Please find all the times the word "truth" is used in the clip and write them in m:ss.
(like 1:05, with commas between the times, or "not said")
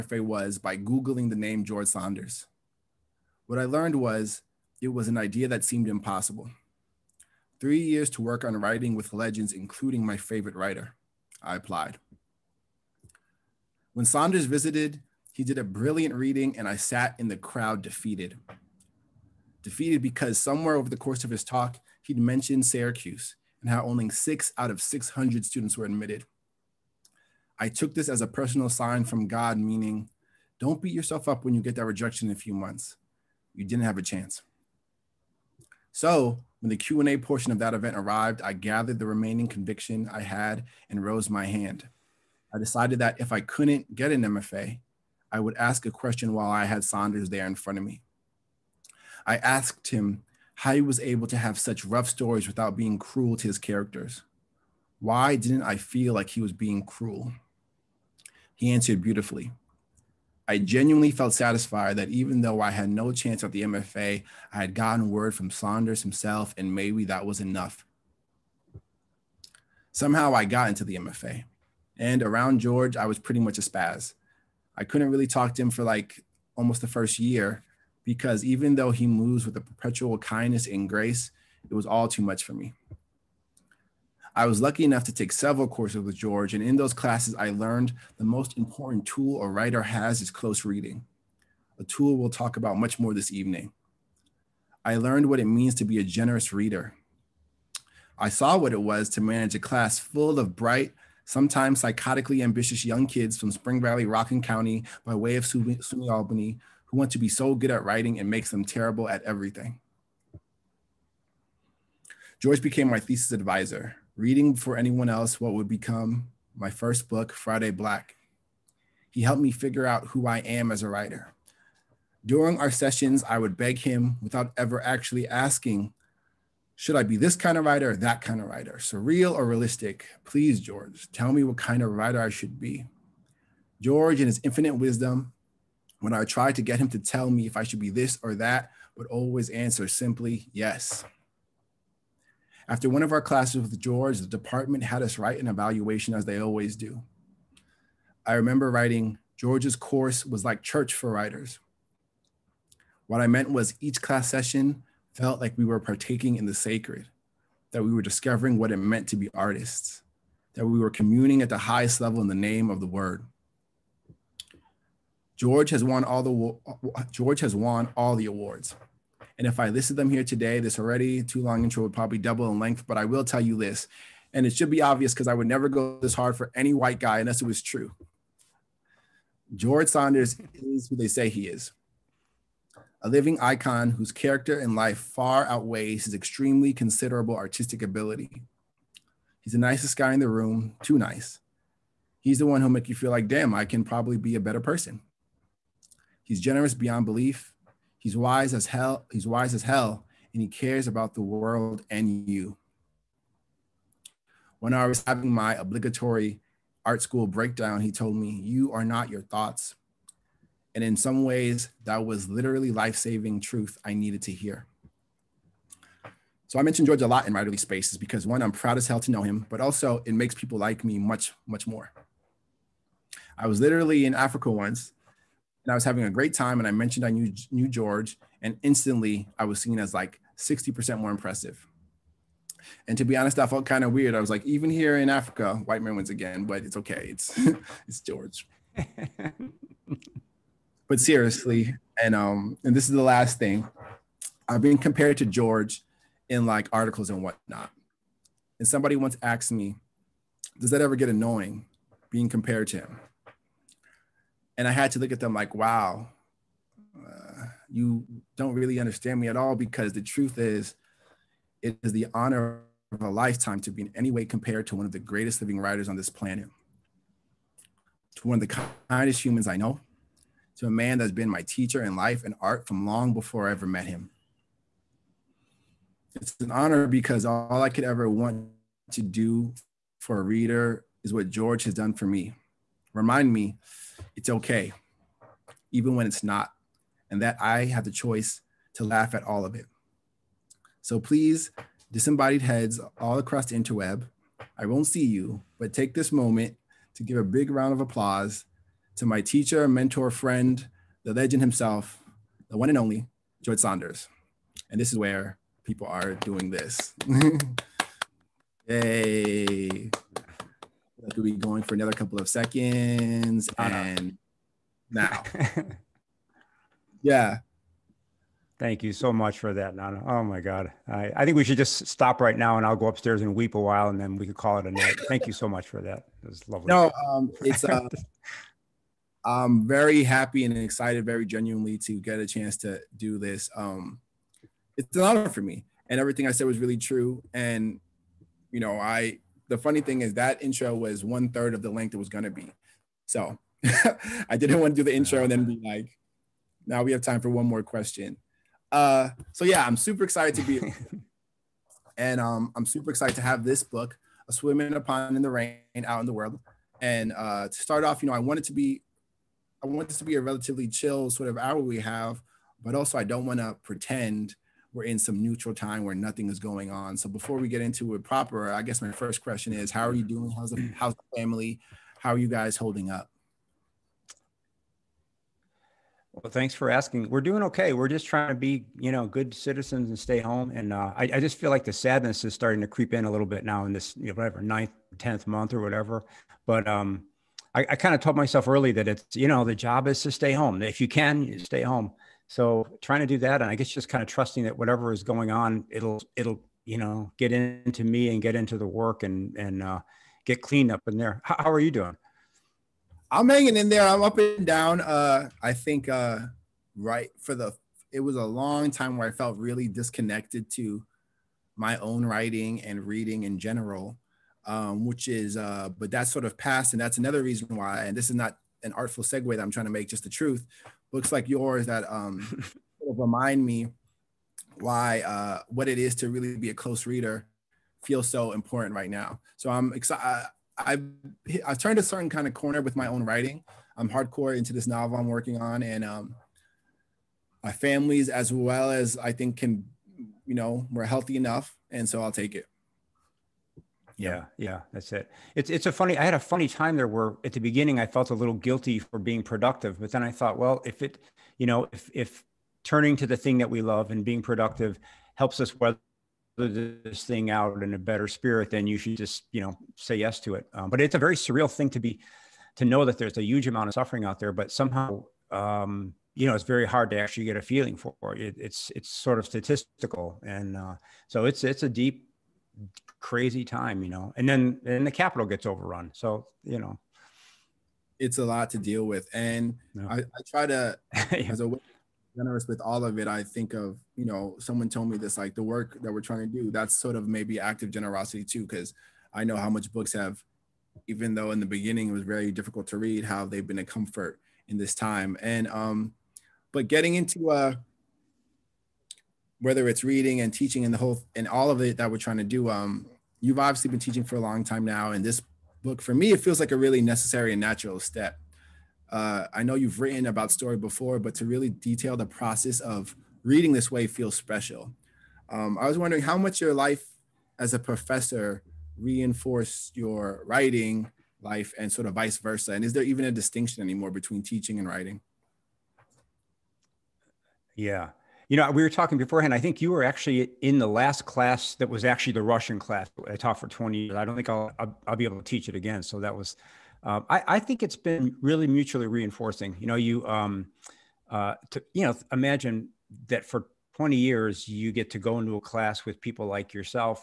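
3:33, 4:20, 7:00.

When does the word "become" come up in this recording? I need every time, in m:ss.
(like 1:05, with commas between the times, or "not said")
1:55.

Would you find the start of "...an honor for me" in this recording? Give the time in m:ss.
5:34.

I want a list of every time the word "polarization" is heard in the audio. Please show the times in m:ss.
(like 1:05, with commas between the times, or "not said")
not said.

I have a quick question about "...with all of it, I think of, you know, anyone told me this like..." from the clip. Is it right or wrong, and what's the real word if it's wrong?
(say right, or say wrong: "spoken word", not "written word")
wrong: "someone", not "anyone".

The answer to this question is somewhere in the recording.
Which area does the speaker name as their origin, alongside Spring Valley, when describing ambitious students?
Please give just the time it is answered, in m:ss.
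1:44.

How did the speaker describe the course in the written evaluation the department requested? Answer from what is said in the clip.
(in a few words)
Church for writers.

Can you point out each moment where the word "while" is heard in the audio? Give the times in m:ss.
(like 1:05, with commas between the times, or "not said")
0:46, 5:23.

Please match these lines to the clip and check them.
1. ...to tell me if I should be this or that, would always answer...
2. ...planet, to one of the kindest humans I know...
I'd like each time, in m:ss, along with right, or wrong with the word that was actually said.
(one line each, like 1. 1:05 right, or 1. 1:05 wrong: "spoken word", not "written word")
1. 2:16 right
2. 4:26 right.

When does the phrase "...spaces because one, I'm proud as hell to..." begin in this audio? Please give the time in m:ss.
3:37.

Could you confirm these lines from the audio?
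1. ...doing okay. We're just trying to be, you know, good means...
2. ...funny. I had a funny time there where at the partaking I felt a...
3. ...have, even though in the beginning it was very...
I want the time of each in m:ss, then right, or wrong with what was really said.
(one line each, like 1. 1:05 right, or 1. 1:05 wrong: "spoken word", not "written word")
1. 6:17 wrong: "citizens", not "means"
2. 7:25 wrong: "beginning", not "partaking"
3. 8:09 right.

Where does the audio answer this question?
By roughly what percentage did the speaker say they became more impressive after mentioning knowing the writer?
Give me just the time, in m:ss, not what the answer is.
3:50.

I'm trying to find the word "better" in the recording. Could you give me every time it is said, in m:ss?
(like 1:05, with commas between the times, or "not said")
3:14, 7:37.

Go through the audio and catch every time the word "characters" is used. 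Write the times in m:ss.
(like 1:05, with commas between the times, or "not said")
0:53, 3:04.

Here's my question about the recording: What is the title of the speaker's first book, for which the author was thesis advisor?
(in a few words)
Friday Black.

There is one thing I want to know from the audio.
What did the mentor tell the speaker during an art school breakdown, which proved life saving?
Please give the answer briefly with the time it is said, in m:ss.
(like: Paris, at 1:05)
You are not your thoughts, at 3:28.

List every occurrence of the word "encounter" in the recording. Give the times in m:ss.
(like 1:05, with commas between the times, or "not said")
not said.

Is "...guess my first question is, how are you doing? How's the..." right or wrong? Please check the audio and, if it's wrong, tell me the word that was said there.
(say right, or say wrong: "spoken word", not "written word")
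right.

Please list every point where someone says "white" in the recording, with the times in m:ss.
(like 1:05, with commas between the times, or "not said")
2:56, 3:55.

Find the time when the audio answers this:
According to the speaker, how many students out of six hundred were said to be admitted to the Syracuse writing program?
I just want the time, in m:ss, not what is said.
0:24.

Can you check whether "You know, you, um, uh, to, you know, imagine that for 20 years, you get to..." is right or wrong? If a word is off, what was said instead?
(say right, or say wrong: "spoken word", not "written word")
right.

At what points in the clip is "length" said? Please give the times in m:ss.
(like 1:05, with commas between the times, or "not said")
2:52, 5:41.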